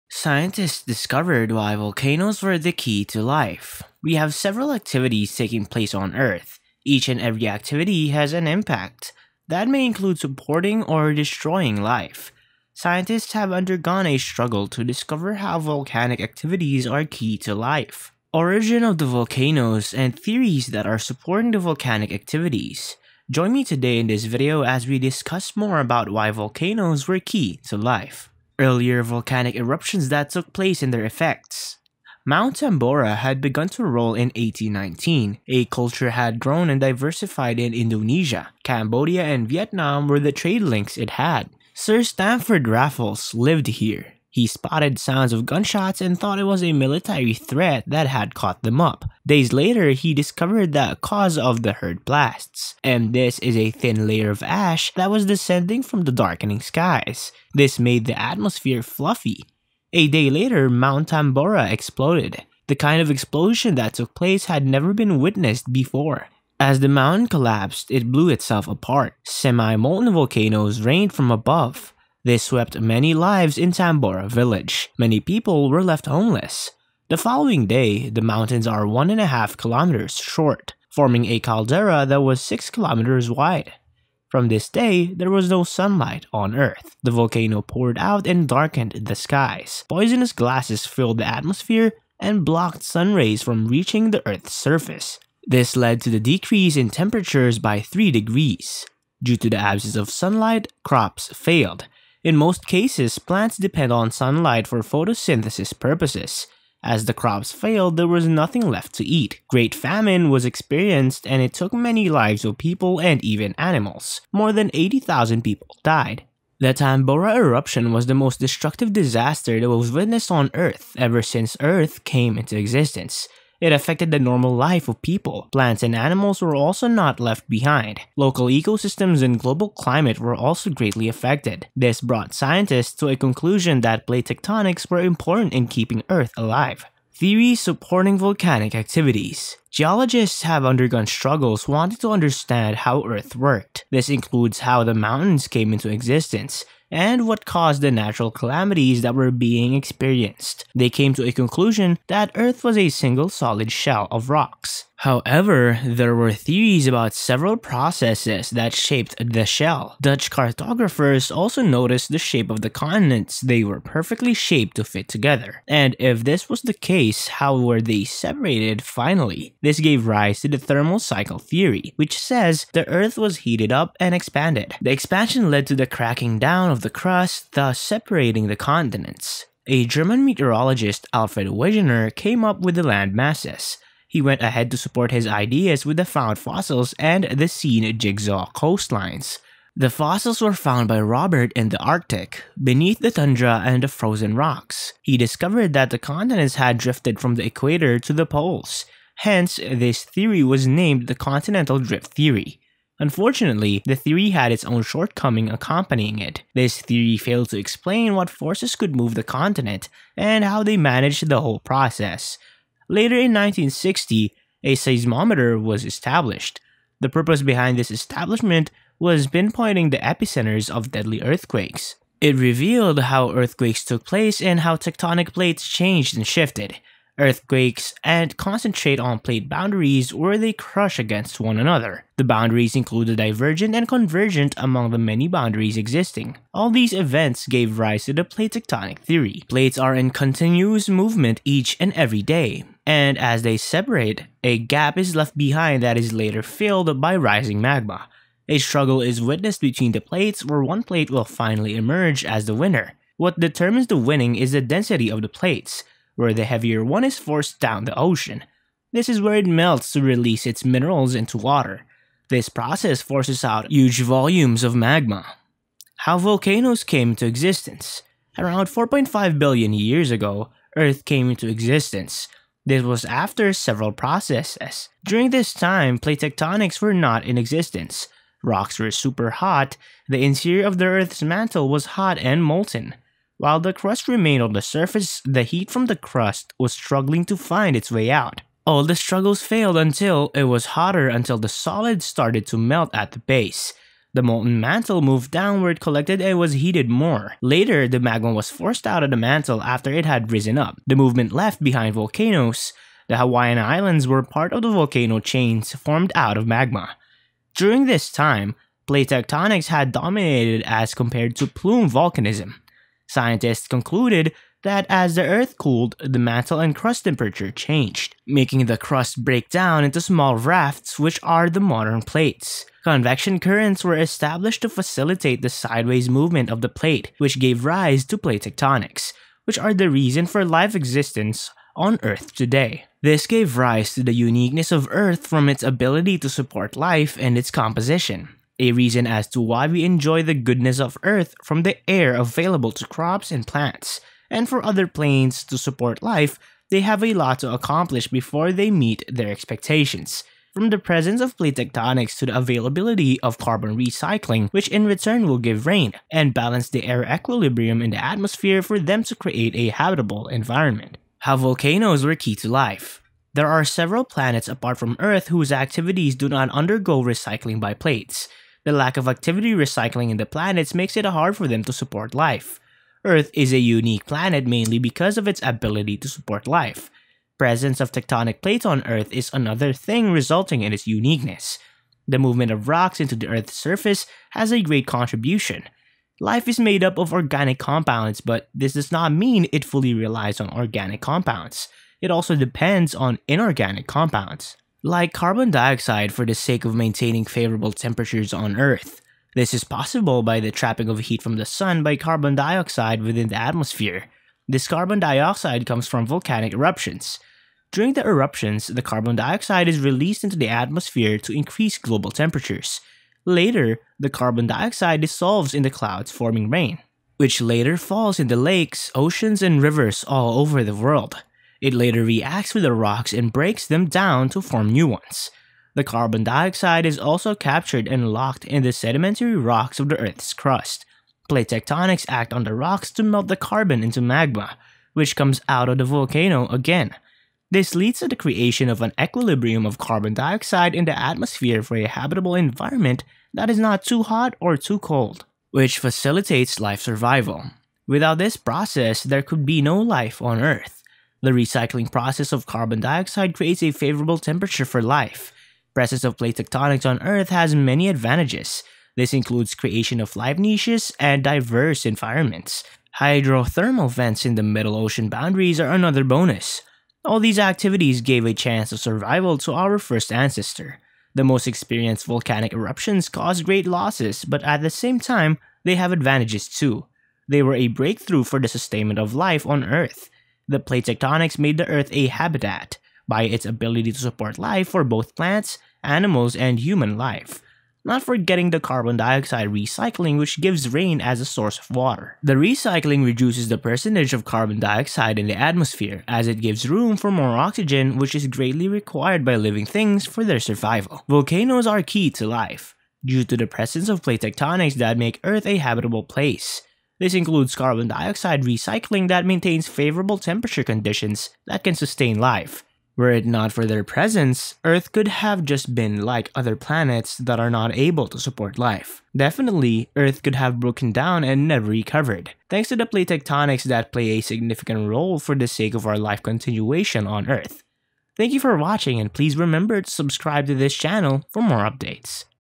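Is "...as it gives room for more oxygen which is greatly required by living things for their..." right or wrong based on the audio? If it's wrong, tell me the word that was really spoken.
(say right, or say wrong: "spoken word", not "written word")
right.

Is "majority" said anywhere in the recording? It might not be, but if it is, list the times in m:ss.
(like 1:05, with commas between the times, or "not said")
not said.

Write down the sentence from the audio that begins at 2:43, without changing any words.
They were perfectly shaped to fit together.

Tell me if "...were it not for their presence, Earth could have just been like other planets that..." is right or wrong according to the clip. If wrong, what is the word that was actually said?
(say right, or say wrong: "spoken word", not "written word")
right.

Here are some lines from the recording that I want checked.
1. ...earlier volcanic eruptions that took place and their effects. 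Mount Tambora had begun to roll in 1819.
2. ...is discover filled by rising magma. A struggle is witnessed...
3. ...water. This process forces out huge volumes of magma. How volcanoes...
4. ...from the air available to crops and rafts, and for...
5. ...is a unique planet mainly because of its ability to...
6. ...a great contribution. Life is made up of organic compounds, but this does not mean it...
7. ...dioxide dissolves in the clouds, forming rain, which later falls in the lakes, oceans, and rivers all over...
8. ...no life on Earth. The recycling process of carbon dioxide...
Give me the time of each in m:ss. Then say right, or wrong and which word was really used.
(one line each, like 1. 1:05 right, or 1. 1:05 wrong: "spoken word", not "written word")
1. 0:28 right
2. 4:05 wrong: "later", not "discover"
3. 4:21 right
4. 5:41 wrong: "plants", not "rafts"
5. 6:13 right
6. 6:24 right
7. 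6:54 right
8. 7:29 right.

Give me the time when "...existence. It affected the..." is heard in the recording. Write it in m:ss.
2:02.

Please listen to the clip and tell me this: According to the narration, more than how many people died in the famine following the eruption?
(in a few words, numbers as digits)
80,000.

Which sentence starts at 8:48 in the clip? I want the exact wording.
Thank you for watching and please remember to subscribe to this channel for more updates.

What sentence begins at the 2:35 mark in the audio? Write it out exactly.
However, there were theories about several processes that shaped the shell.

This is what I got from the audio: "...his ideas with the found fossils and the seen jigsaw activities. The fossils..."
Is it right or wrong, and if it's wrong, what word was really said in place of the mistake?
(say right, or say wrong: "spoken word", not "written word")
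wrong: "coastlines", not "activities".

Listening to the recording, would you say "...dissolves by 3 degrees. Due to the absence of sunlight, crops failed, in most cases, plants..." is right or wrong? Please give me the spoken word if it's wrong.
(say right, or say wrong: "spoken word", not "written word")
wrong: "temperatures", not "dissolves".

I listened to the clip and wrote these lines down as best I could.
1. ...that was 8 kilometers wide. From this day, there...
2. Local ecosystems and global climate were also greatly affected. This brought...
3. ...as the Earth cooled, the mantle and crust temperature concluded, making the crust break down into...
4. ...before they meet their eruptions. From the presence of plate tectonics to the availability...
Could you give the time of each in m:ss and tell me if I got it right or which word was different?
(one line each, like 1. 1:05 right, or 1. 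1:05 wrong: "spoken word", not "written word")
1. 1:22 wrong: "6", not "8"
2. 2:08 right
3. 5:14 wrong: "changed", not "concluded"
4. 5:48 wrong: "expectations", not "eruptions".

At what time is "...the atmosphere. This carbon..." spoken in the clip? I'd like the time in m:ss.
6:43.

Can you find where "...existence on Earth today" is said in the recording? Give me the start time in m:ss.
5:30.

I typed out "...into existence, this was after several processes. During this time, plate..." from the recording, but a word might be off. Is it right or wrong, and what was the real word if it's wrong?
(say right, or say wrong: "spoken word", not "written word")
right.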